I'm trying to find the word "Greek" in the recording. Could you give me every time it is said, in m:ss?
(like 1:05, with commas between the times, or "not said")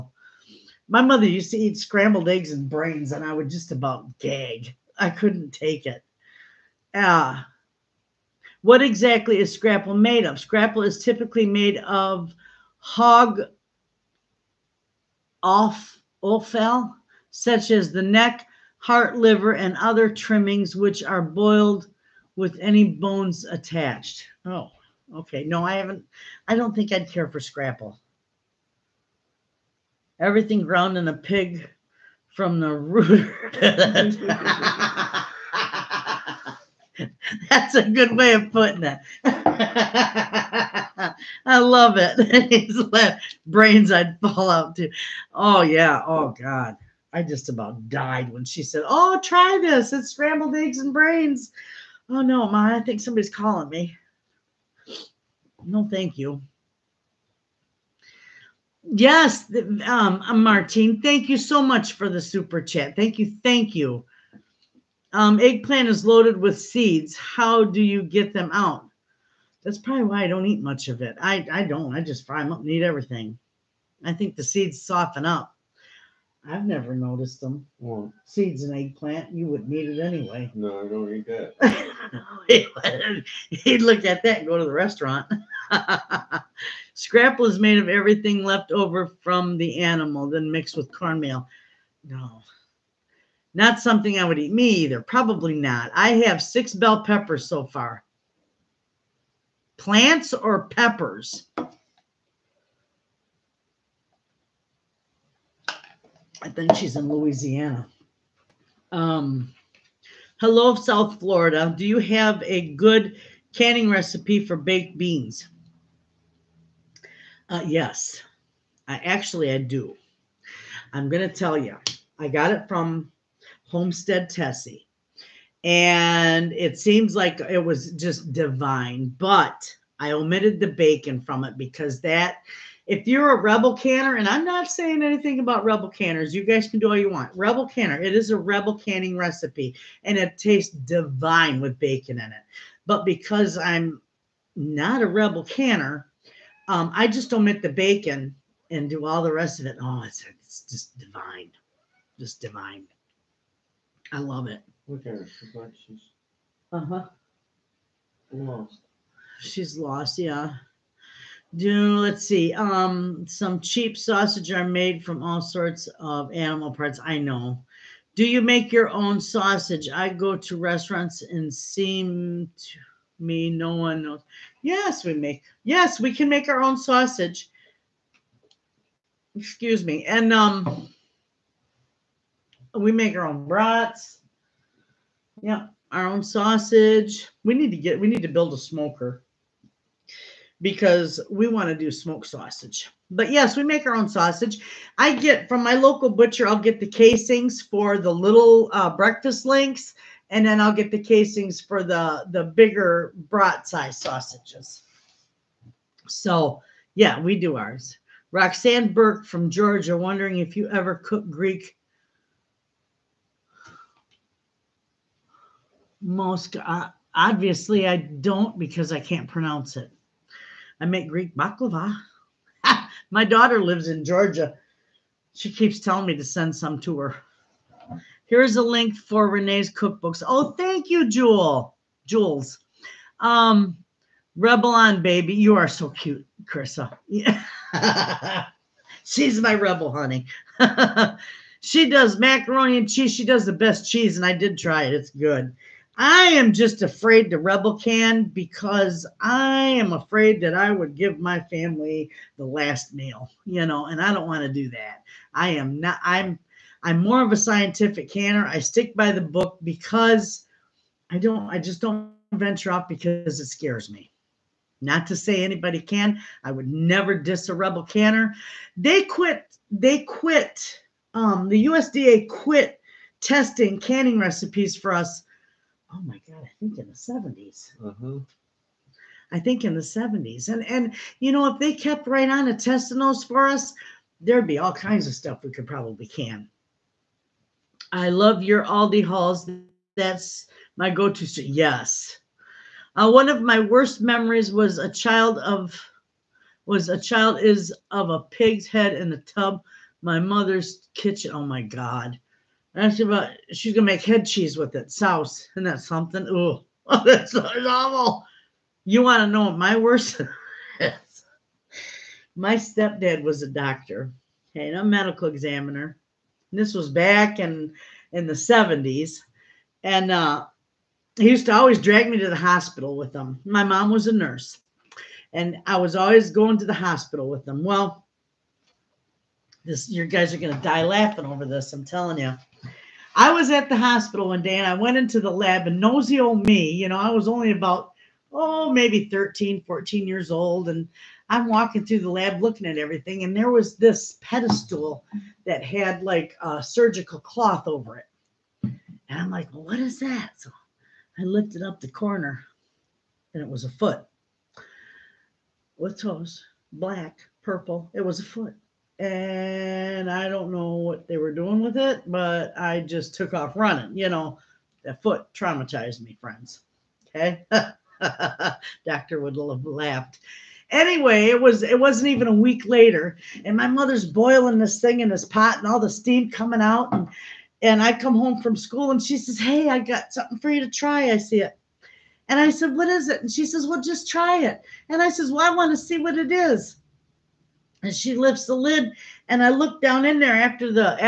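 3:31, 3:41.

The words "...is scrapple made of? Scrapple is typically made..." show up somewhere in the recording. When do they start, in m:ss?
0:09.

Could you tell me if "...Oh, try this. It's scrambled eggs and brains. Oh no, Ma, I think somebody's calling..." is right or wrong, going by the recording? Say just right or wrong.
right.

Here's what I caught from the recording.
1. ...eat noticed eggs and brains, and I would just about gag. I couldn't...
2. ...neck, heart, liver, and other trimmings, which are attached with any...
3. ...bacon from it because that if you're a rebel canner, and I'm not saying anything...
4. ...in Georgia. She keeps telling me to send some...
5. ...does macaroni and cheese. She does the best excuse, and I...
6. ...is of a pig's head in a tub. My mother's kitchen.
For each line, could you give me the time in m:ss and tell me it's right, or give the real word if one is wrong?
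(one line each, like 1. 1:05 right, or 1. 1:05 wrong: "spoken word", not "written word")
1. 0:01 wrong: "scrambled", not "noticed"
2. 0:18 wrong: "boiled", not "attached"
3. 2:10 right
4. 3:43 right
5. 4:01 wrong: "cheese", not "excuse"
6. 4:57 right.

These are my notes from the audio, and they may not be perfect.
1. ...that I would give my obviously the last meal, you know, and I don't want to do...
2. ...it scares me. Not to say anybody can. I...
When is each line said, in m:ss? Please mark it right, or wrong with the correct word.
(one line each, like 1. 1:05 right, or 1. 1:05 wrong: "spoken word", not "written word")
1. 4:10 wrong: "family", not "obviously"
2. 4:23 right.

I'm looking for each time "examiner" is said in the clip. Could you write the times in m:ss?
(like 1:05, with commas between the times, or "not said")
5:15.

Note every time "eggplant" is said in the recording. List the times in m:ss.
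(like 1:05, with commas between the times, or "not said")
1:05, 1:18.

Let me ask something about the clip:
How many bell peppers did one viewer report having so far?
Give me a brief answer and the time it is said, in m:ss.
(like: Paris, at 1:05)
6, at 1:36.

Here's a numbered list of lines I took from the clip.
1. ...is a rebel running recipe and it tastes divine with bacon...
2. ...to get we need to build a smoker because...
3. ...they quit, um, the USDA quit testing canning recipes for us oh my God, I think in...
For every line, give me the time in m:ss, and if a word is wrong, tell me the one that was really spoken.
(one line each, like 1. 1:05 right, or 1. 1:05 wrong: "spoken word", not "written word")
1. 2:18 wrong: "canning", not "running"
2. 3:07 right
3. 4:29 right.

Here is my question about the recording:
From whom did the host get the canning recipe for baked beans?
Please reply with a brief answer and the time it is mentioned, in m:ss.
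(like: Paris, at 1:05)
Homestead Tessie, at 2:03.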